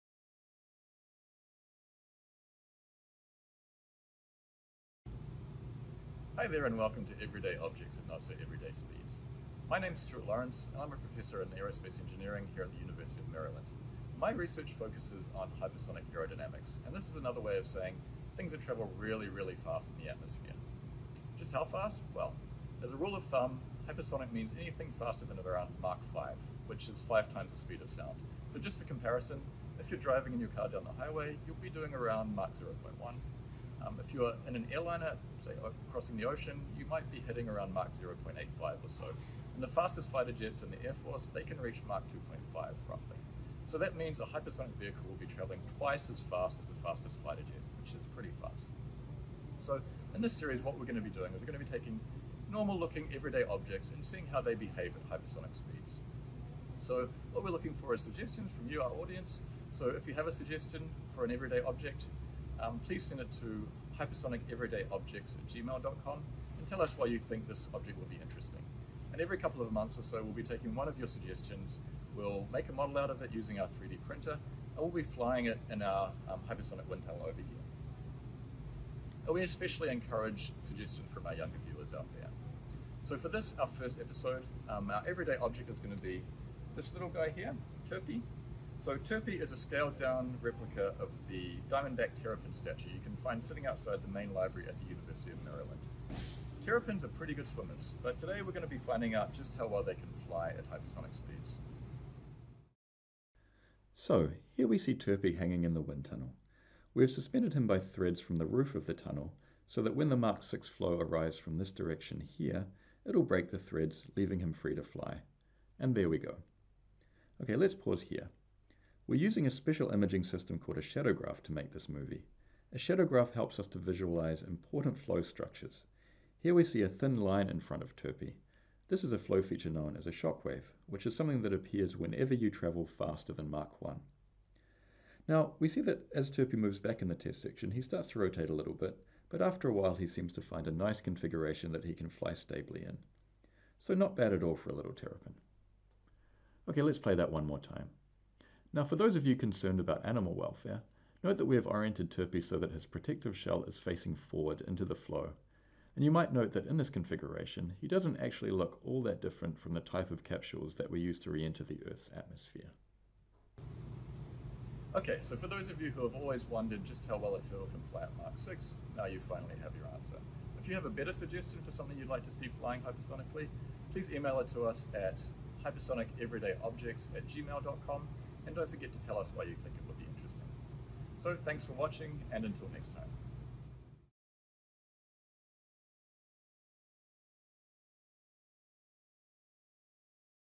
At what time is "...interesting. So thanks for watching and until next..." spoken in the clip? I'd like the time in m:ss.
3:00.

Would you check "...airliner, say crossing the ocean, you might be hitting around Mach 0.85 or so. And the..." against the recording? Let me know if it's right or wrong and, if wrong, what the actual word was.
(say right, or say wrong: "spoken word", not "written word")
right.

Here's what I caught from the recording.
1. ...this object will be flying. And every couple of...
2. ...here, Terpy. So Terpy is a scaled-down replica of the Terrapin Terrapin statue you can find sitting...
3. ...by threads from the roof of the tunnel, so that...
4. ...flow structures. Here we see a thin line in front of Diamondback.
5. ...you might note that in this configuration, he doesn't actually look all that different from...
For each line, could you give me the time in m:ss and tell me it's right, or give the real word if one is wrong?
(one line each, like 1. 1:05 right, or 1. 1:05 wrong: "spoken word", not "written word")
1. 1:07 wrong: "interesting", not "flying"
2. 1:27 wrong: "Diamondback", not "Terrapin"
3. 1:47 right
4. 2:04 wrong: "Terpy", not "Diamondback"
5. 2:36 right.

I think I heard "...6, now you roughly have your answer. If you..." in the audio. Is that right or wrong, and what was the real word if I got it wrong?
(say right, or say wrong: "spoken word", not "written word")
wrong: "finally", not "roughly".